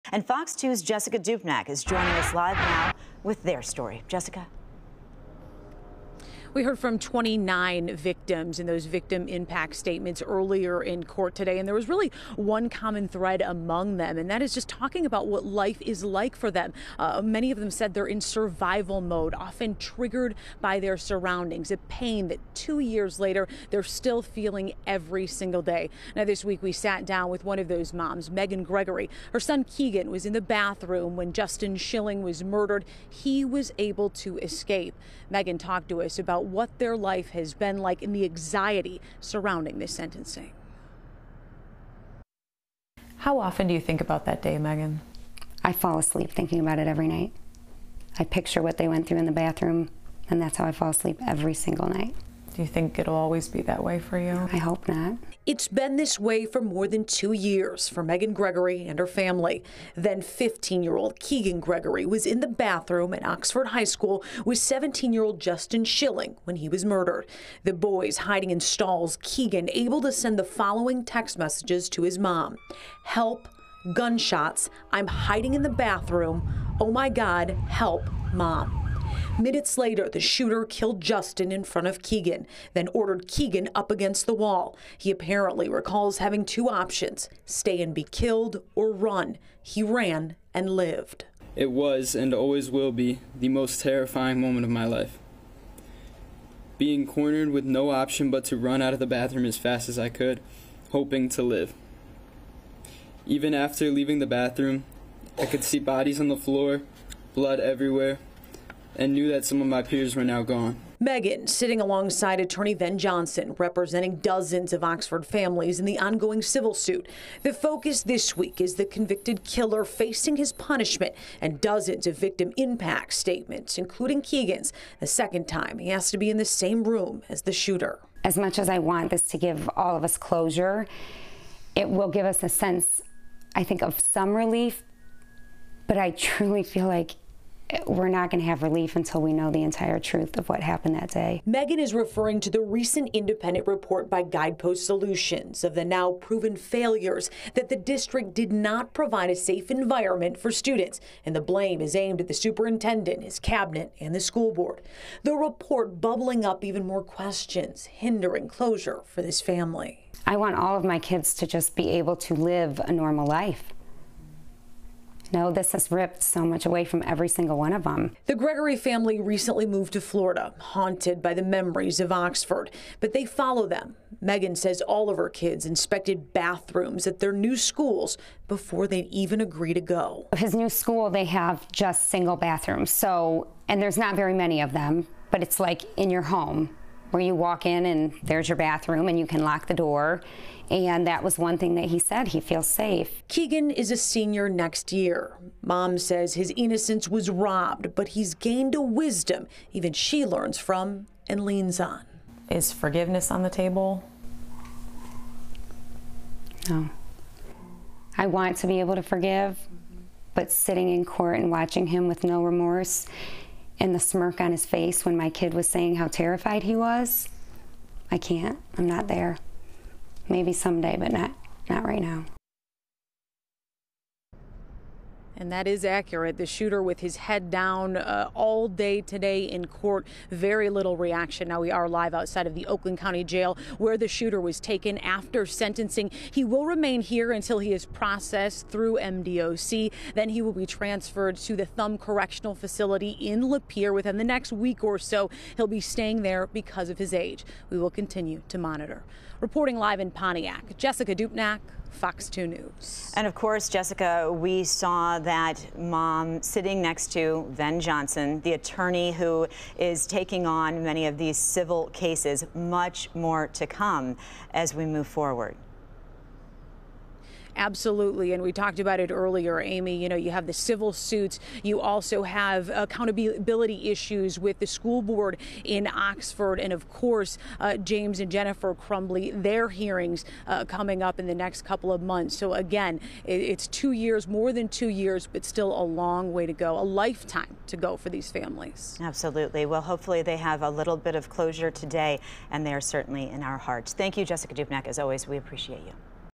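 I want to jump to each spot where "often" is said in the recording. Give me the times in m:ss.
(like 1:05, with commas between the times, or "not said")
0:19, 0:43.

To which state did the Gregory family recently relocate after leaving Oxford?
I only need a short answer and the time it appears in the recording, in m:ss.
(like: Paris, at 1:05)
Florida, at 2:50.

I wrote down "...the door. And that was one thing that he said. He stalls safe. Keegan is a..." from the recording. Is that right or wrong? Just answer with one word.
wrong.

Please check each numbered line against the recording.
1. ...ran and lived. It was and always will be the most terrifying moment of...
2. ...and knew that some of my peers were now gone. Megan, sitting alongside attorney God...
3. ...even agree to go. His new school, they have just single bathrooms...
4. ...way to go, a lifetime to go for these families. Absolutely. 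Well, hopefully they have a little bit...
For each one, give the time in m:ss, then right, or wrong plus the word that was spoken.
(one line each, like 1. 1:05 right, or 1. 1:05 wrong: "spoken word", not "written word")
1. 1:29 right
2. 1:48 wrong: "Ben", not "God"
3. 2:59 right
4. 4:46 right.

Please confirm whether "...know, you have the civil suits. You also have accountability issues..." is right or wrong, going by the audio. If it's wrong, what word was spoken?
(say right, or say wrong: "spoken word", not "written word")
right.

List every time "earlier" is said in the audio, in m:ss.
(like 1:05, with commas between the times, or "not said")
0:10, 4:29.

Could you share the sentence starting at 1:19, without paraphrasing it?
Minutes later, the shooter killed Justin in front of Keegan, then ordered Keegan up against the wall.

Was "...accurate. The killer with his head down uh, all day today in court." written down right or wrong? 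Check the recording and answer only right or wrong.
wrong.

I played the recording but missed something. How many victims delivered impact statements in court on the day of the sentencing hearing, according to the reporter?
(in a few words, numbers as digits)
29.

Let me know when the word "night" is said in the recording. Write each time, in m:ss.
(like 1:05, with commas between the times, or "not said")
0:47, 0:51.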